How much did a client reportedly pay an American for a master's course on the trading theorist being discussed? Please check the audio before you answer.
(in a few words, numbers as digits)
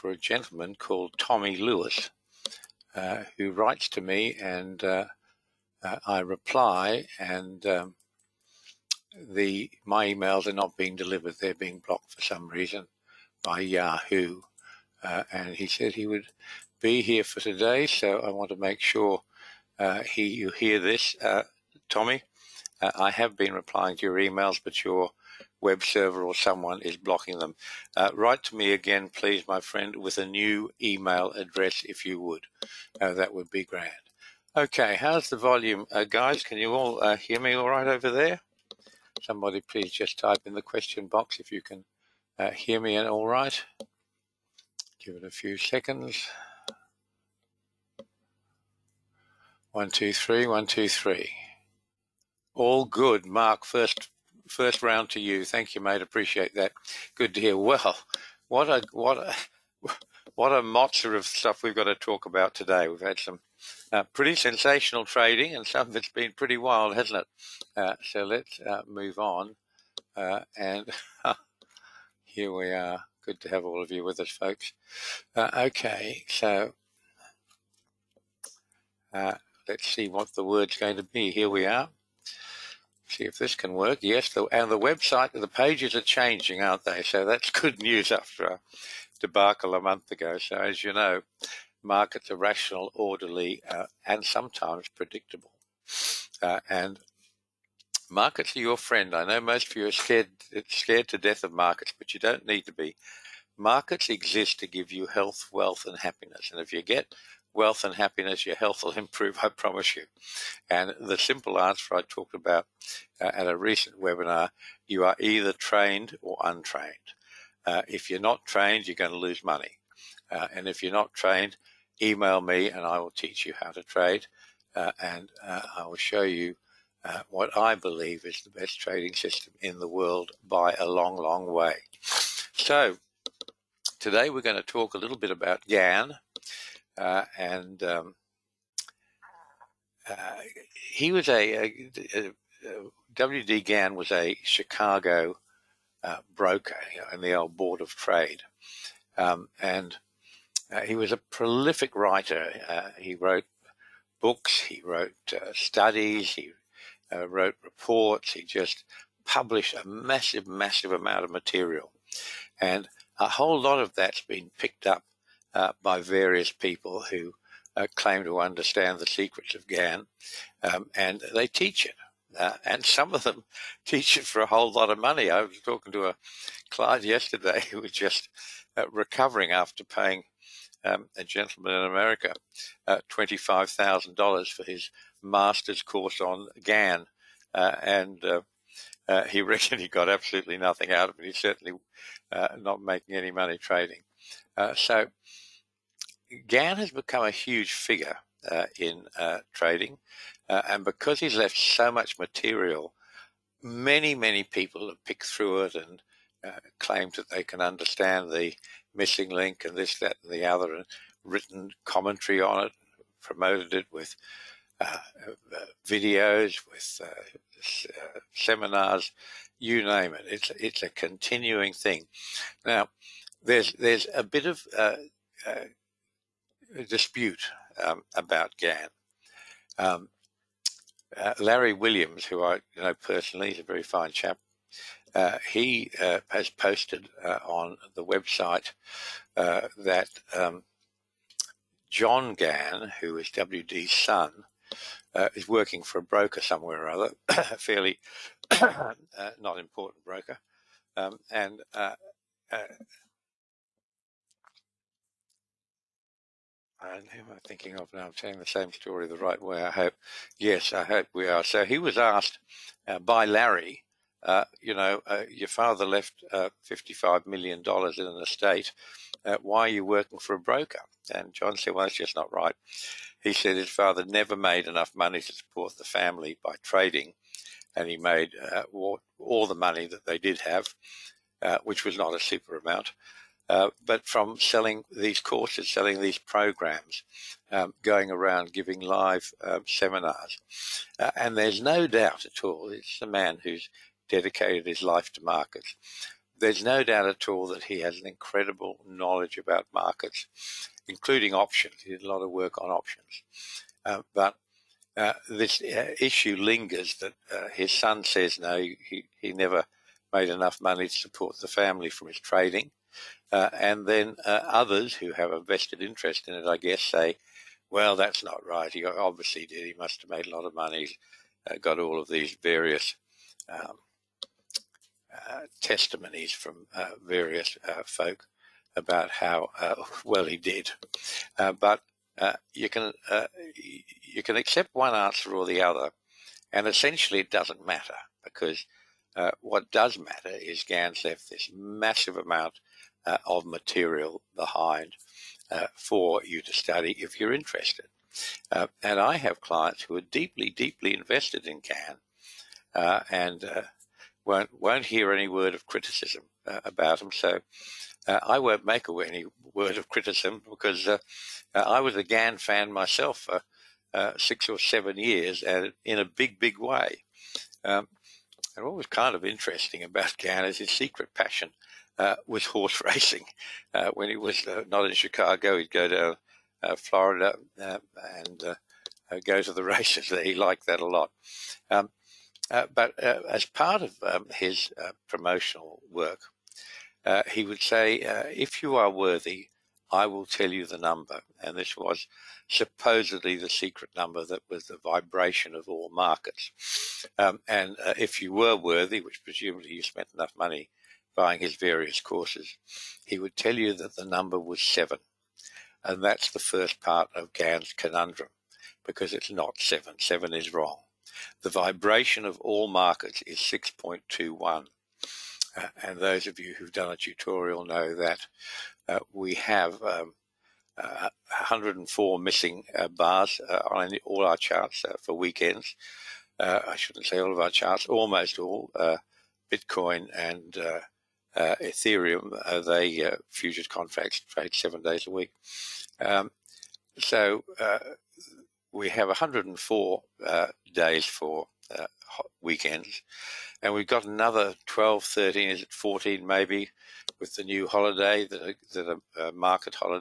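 $25,000.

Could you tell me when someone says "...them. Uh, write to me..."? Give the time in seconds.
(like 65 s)
27 s.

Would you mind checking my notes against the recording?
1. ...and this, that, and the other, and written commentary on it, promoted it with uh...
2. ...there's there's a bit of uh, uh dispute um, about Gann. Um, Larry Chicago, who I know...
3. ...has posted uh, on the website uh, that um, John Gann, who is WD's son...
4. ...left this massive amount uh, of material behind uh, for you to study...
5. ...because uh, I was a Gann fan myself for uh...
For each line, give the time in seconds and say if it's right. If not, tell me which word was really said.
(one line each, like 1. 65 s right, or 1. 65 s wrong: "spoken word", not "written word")
1. 209 s right
2. 223 s wrong: "Williams", not "Chicago"
3. 236 s right
4. 341 s right
5. 360 s right.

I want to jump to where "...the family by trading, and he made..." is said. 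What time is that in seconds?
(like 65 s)
275 s.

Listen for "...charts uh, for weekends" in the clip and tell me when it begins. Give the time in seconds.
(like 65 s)
424 s.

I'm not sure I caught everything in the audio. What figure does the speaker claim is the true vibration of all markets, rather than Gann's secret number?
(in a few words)
6.21.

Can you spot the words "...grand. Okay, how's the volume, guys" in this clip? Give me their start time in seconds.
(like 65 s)
33 s.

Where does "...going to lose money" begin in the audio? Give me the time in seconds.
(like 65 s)
118 s.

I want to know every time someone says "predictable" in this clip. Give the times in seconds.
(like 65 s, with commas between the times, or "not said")
94 s.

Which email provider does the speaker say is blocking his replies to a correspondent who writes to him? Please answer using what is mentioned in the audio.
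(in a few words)
Yahoo.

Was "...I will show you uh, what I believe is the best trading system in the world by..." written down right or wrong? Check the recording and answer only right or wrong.
right.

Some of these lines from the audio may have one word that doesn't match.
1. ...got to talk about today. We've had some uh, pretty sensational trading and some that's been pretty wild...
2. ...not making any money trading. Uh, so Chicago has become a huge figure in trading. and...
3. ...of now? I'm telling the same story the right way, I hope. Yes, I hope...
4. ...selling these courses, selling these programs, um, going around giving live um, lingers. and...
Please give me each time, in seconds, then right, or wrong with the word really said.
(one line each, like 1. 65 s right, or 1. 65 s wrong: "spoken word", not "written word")
1. 61 s right
2. 192 s wrong: "Gann", not "Chicago"
3. 257 s right
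4. 284 s wrong: "seminars", not "lingers".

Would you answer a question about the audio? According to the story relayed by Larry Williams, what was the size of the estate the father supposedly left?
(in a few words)
$55 million.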